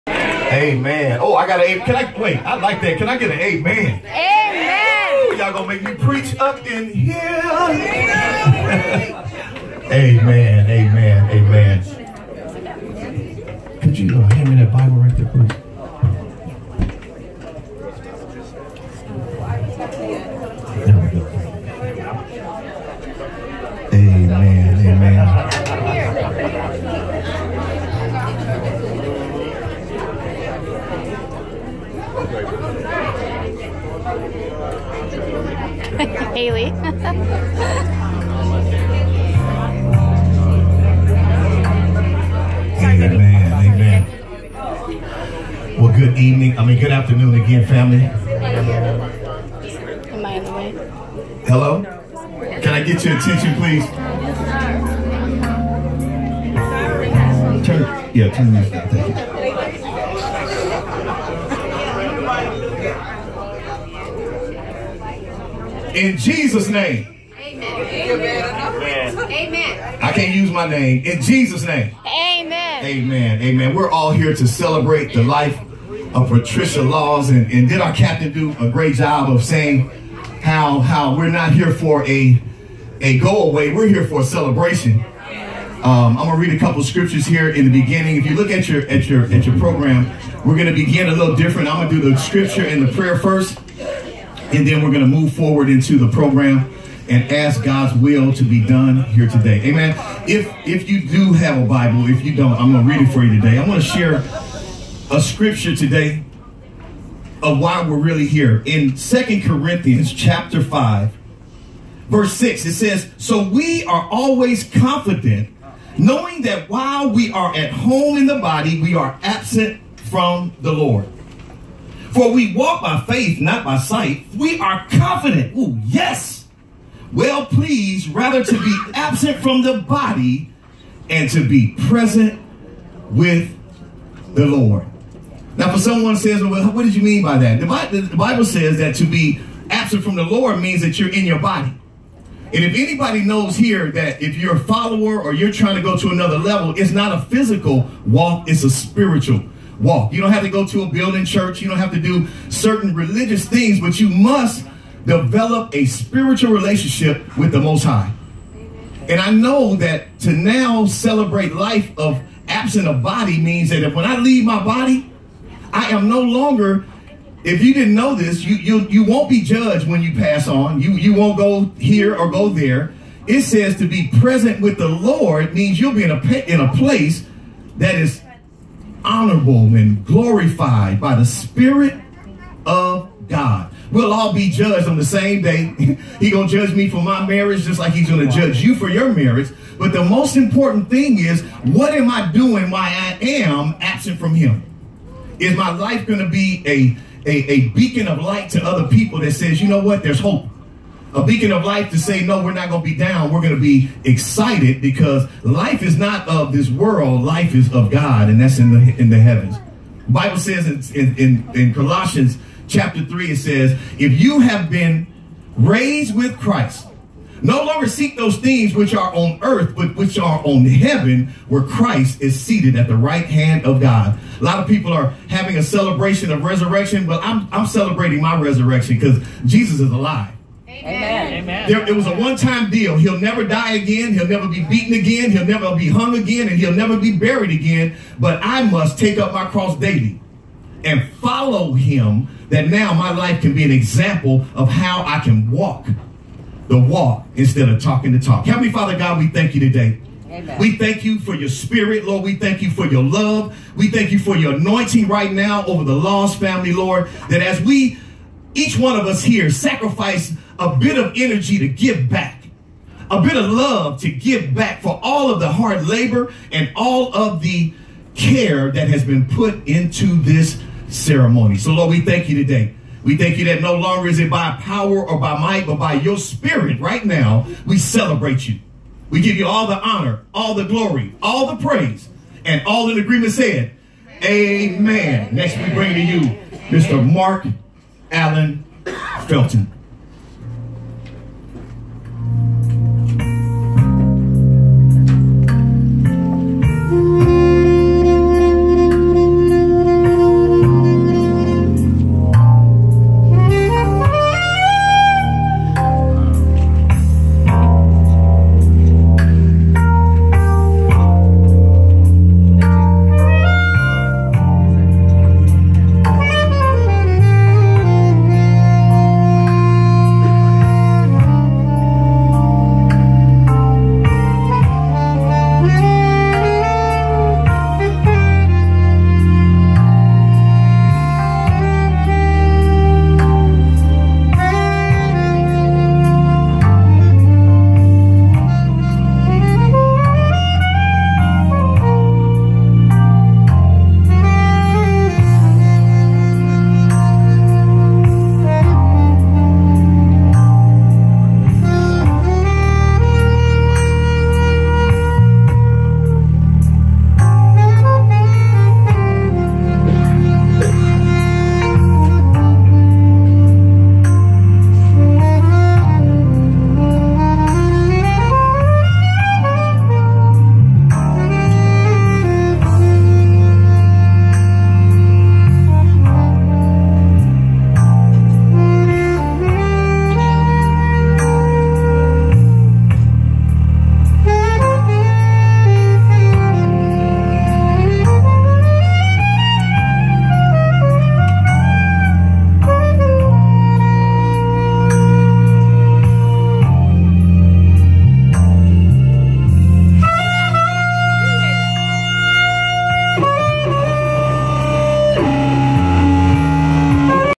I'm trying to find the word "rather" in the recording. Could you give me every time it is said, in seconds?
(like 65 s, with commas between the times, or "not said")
128 s.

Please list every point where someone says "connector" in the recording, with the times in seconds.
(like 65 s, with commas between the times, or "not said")
not said.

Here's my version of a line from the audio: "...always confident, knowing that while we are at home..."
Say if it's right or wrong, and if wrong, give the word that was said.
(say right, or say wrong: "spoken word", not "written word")
right.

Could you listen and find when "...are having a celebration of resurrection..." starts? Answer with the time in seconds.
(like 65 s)
224 s.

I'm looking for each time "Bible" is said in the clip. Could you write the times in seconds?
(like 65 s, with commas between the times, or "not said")
14 s, 101 s, 138 s, 210 s.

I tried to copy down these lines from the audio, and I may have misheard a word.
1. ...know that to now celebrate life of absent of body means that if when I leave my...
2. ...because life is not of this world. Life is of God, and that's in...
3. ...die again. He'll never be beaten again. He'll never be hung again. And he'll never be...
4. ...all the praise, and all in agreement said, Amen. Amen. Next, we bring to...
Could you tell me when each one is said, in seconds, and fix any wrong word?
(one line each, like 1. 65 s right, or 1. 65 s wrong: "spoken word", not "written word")
1. 159 s right
2. 204 s right
3. 233 s right
4. 281 s right.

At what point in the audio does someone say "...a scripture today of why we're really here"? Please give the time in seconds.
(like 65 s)
105 s.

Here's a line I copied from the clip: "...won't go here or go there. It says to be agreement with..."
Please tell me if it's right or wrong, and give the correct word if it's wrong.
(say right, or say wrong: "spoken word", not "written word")
wrong: "present", not "agreement".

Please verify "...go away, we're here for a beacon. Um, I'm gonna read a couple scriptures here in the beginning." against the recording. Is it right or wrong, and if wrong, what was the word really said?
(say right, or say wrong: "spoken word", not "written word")
wrong: "celebration", not "beacon".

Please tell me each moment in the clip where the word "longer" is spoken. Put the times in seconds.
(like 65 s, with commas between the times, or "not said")
166 s, 217 s, 273 s.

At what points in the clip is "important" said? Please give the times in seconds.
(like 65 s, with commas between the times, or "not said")
190 s.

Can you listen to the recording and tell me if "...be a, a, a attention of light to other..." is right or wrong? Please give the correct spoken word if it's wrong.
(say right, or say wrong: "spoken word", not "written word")
wrong: "beacon", not "attention".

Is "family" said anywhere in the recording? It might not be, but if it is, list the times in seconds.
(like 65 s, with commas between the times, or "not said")
47 s, 256 s.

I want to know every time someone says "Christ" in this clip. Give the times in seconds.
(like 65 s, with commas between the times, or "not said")
216 s, 221 s.